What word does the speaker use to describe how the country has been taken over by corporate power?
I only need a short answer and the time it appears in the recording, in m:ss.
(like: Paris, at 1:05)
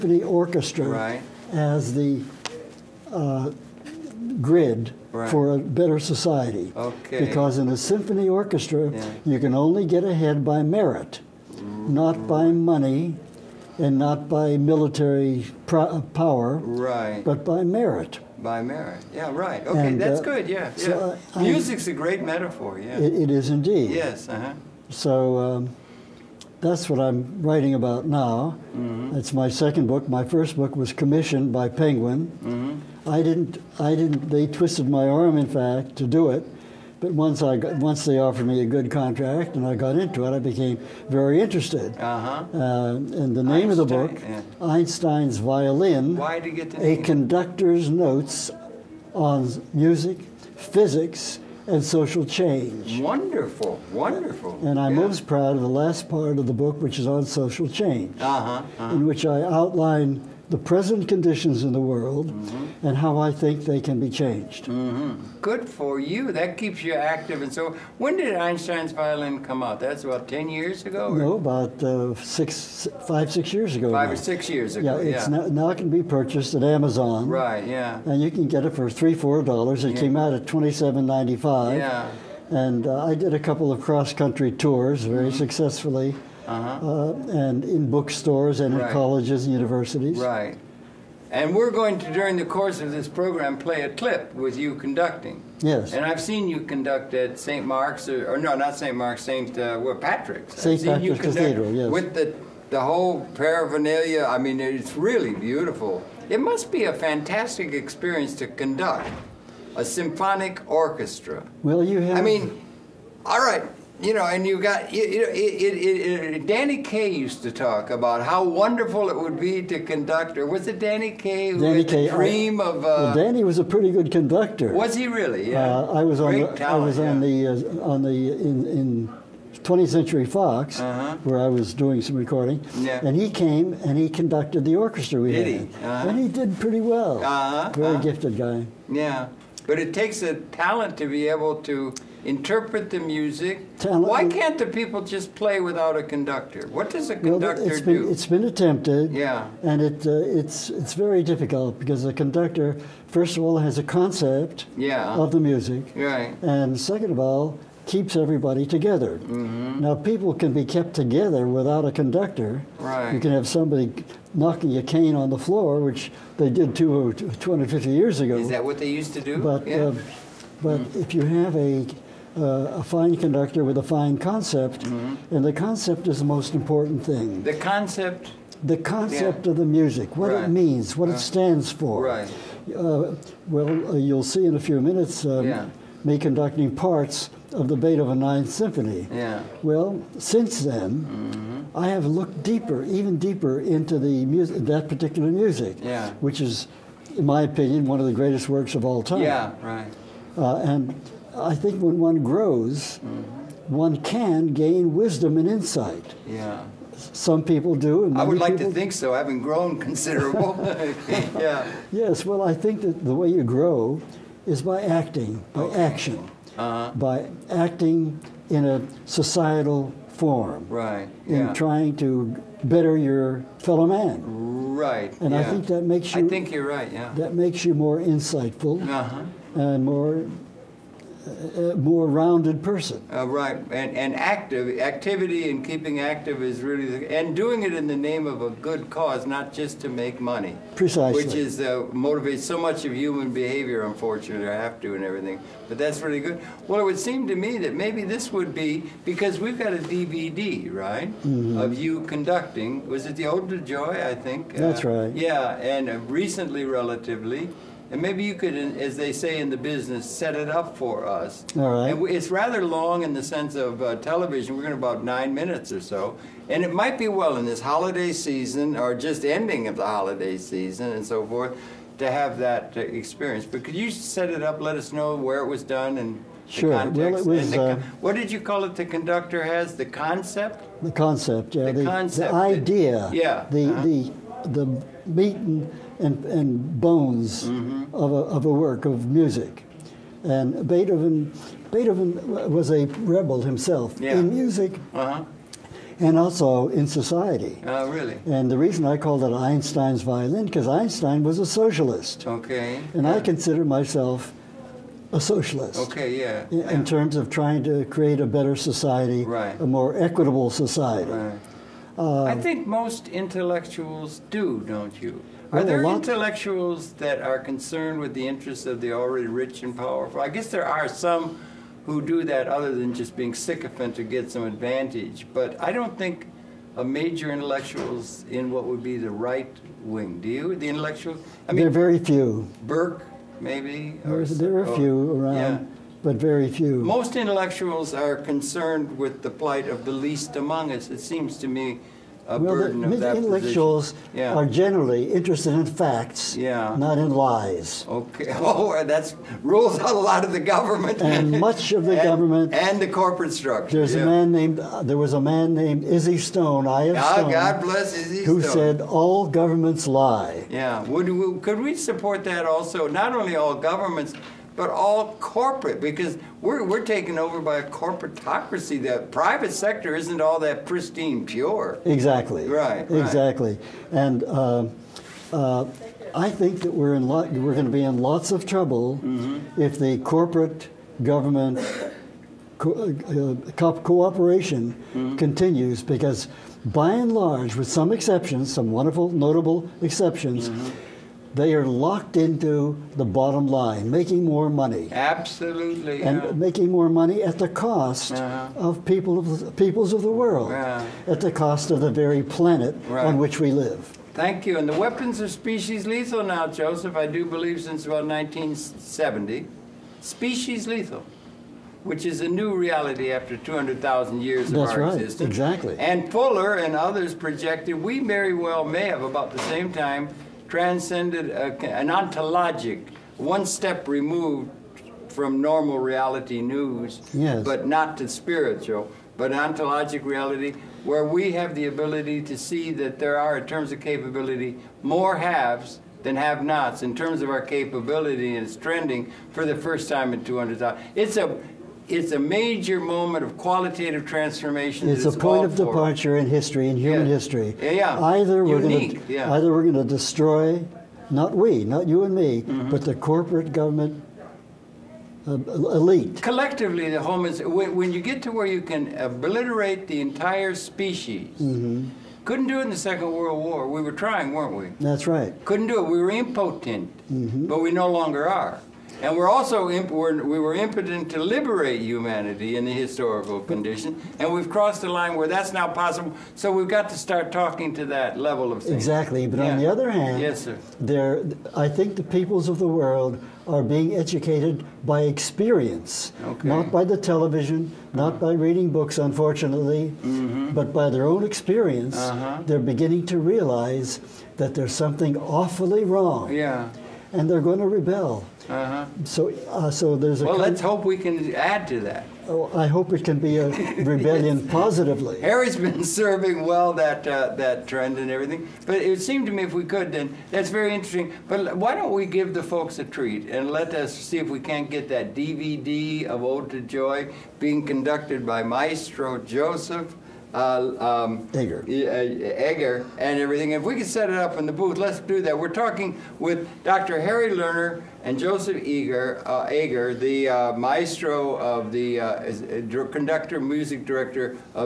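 corporatocracy, at 6:07.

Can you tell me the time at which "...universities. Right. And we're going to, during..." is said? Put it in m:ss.
1:29.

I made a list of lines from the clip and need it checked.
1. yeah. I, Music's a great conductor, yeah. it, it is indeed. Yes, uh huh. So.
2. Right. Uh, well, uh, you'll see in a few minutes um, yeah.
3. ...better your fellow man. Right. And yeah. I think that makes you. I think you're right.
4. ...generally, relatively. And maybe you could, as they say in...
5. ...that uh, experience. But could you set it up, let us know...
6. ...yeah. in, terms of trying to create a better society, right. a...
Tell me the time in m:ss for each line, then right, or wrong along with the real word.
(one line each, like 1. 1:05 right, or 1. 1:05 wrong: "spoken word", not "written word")
1. 0:20 wrong: "metaphor", not "conductor"
2. 3:02 right
3. 3:42 right
4. 4:16 wrong: "recently", not "generally"
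5. 4:32 right
6. 5:06 right.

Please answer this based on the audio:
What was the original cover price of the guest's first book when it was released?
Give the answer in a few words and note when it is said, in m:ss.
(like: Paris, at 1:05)
$27.95, at 1:20.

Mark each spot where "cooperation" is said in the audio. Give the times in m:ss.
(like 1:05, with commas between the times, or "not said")
6:23.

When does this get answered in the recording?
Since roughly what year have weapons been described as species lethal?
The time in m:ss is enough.
6:48.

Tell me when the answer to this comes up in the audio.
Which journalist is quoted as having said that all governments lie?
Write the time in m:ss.
5:55.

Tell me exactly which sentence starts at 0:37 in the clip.
But once I got, once they offered me a good contract and I got into it, I became very interested.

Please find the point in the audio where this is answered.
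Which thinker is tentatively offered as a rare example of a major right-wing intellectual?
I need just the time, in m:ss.
5:32.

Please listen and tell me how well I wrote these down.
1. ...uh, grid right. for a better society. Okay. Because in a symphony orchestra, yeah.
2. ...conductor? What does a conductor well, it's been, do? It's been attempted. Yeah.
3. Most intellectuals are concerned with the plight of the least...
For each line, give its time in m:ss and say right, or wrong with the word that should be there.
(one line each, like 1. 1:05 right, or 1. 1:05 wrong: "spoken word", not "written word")
1. 0:03 right
2. 2:26 right
3. 5:36 right.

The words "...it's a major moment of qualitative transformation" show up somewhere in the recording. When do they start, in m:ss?
7:21.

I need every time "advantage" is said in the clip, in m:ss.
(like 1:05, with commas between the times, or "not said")
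5:24.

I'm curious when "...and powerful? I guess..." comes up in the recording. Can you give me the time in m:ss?
5:19.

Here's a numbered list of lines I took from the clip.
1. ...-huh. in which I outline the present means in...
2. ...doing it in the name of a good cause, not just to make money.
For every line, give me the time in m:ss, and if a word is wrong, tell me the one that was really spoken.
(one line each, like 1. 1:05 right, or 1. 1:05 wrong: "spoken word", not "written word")
1. 0:58 wrong: "conditions", not "means"
2. 3:57 right.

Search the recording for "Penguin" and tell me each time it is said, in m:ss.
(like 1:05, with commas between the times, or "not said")
0:31.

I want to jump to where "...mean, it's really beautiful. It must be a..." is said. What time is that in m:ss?
1:44.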